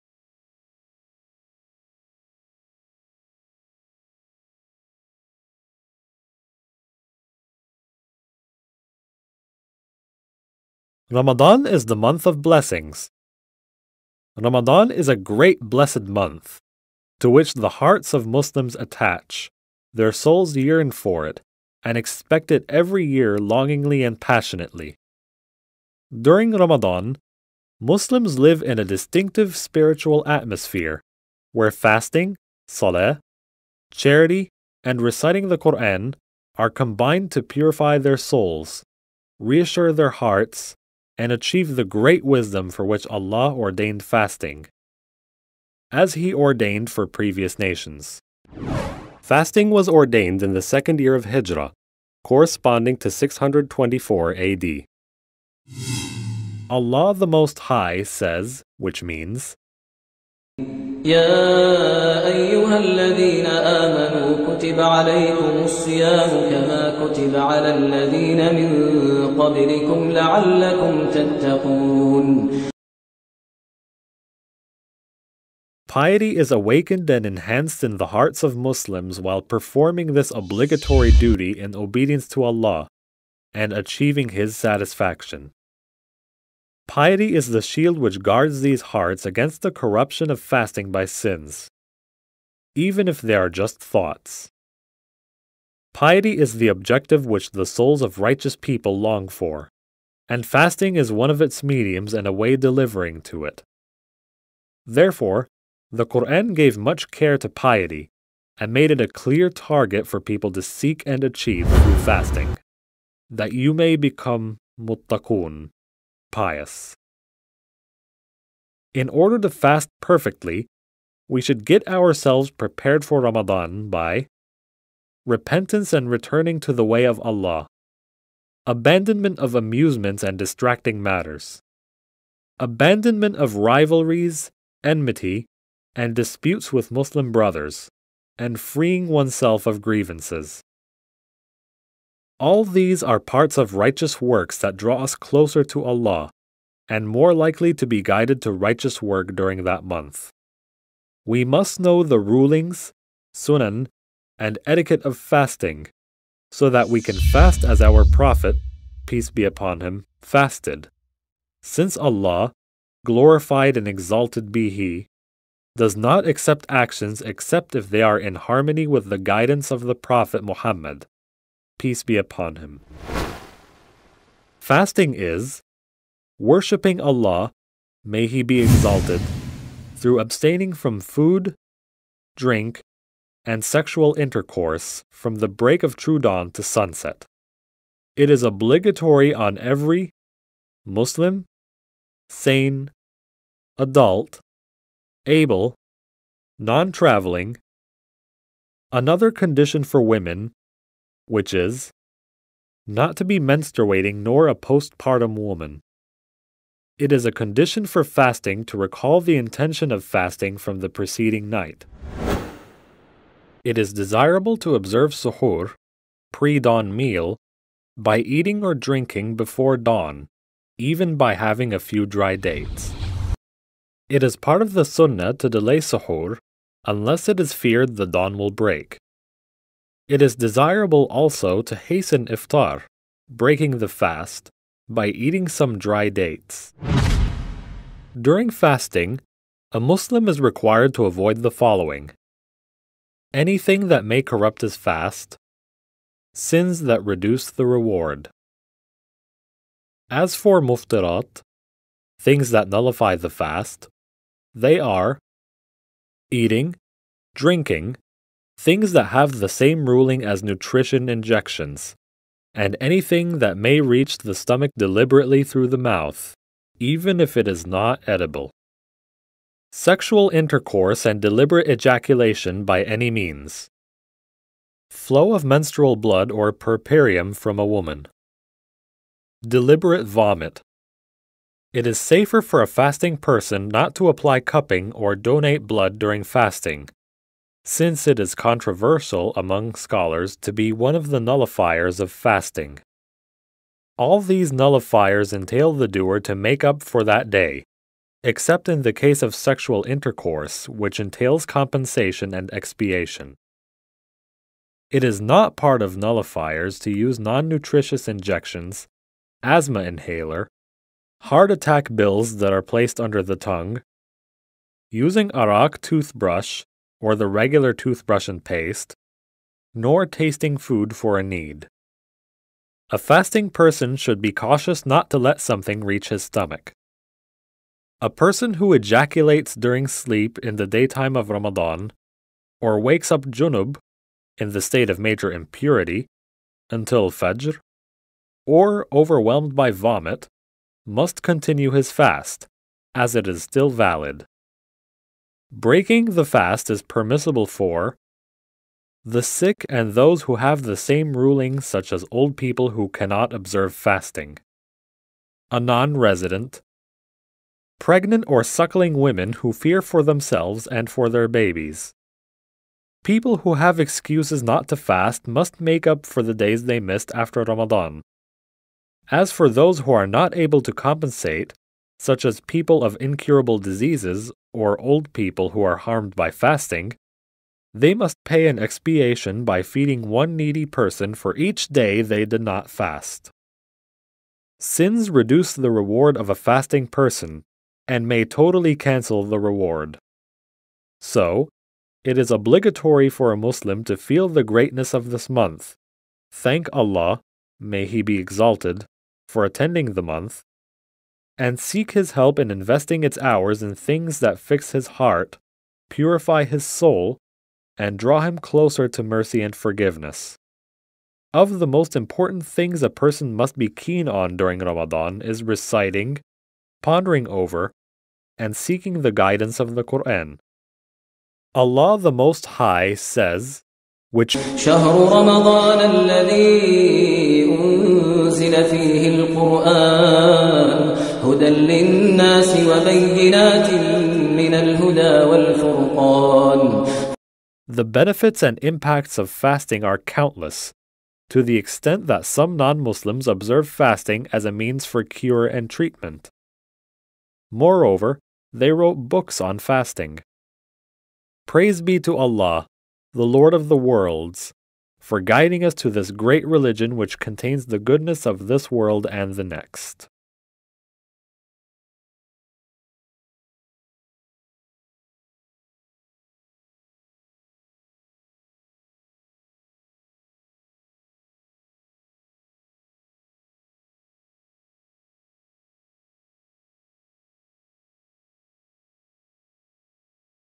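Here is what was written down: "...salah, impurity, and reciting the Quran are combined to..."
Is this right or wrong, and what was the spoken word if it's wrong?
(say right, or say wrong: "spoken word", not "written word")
wrong: "charity", not "impurity".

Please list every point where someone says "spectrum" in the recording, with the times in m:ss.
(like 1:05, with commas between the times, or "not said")
not said.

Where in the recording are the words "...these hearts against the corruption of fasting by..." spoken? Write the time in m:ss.
1:28.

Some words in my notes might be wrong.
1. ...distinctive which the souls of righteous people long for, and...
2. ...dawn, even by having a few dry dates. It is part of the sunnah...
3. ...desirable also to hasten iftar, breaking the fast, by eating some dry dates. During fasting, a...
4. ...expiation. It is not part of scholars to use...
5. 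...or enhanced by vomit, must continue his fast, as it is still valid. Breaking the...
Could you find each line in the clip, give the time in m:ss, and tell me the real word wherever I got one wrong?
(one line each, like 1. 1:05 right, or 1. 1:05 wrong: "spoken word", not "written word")
1. 1:36 wrong: "objective", not "distinctive"
2. 3:39 right
3. 3:50 right
4. 5:02 wrong: "nullifiers", not "scholars"
5. 5:38 wrong: "overwhelmed", not "enhanced".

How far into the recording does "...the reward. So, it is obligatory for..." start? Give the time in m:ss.
6:29.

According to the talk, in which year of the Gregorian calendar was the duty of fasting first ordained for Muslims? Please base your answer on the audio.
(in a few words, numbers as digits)
624 AD.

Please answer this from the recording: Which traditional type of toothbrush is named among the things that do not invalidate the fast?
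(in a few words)
arak.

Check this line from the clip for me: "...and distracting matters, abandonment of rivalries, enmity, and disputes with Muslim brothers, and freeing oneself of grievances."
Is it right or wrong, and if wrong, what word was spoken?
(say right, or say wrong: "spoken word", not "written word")
right.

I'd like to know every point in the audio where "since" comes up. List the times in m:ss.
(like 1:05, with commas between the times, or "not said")
2:41, 4:47.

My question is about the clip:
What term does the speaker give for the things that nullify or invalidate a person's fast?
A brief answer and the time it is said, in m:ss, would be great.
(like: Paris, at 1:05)
muftirat, at 4:10.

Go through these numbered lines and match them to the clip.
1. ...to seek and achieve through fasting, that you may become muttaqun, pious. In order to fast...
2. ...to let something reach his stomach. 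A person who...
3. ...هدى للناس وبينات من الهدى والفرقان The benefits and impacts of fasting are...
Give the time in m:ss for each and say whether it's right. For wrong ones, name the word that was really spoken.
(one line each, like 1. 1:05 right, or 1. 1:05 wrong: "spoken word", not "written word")
1. 1:50 right
2. 5:25 right
3. 7:11 right.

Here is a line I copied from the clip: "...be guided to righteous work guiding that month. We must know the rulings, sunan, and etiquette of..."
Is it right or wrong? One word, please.
wrong.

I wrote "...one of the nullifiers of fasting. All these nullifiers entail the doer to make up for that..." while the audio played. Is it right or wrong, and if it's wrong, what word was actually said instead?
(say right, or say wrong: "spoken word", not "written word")
right.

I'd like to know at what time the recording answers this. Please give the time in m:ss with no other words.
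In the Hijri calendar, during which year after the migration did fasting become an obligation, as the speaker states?
0:50.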